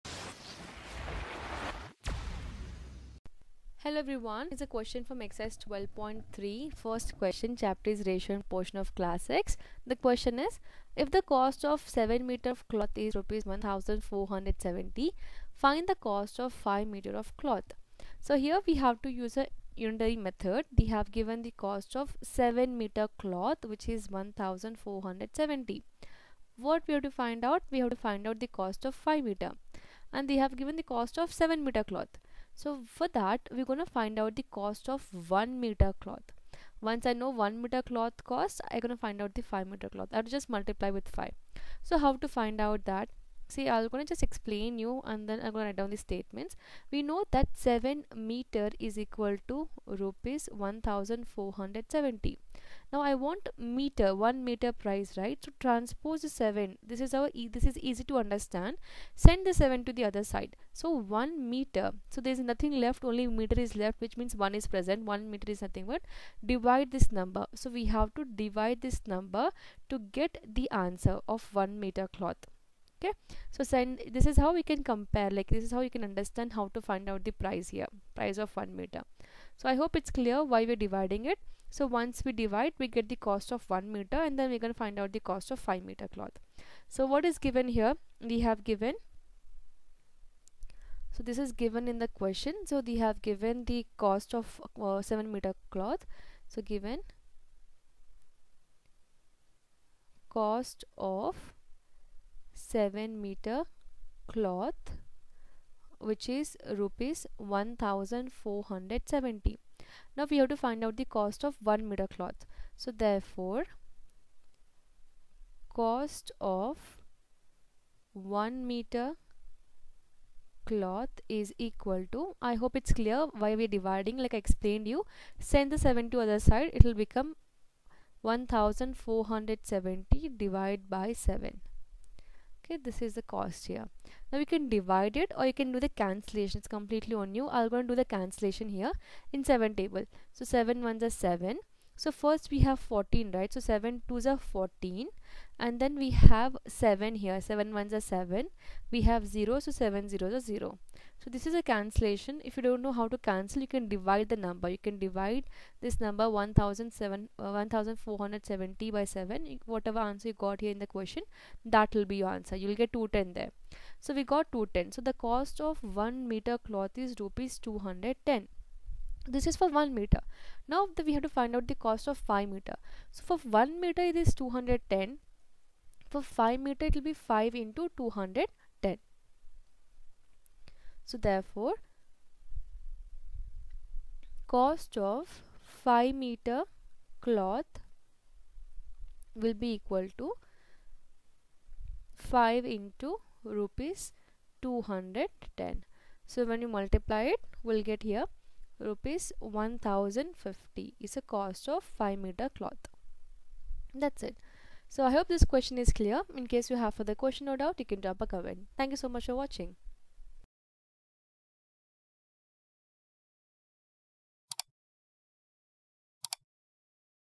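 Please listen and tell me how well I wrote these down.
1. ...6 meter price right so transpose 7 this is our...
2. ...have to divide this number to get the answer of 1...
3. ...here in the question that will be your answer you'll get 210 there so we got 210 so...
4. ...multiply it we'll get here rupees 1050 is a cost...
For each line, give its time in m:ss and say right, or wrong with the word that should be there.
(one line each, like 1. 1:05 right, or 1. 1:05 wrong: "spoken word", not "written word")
1. 0:54 wrong: "1", not "6"
2. 1:07 right
3. 2:40 right
4. 3:16 right.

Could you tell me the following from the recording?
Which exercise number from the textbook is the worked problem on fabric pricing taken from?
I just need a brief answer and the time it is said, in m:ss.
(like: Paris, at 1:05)
12.3, at 0:05.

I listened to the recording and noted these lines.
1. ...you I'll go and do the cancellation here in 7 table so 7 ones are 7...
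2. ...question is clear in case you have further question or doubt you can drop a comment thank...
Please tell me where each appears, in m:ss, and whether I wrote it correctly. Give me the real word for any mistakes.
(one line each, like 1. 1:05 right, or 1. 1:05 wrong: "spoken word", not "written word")
1. 2:17 right
2. 3:25 right.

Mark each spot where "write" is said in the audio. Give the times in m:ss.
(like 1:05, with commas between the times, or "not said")
0:45.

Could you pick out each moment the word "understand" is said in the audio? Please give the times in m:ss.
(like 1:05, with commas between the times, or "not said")
0:58, 1:16.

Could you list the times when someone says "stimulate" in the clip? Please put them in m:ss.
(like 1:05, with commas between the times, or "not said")
not said.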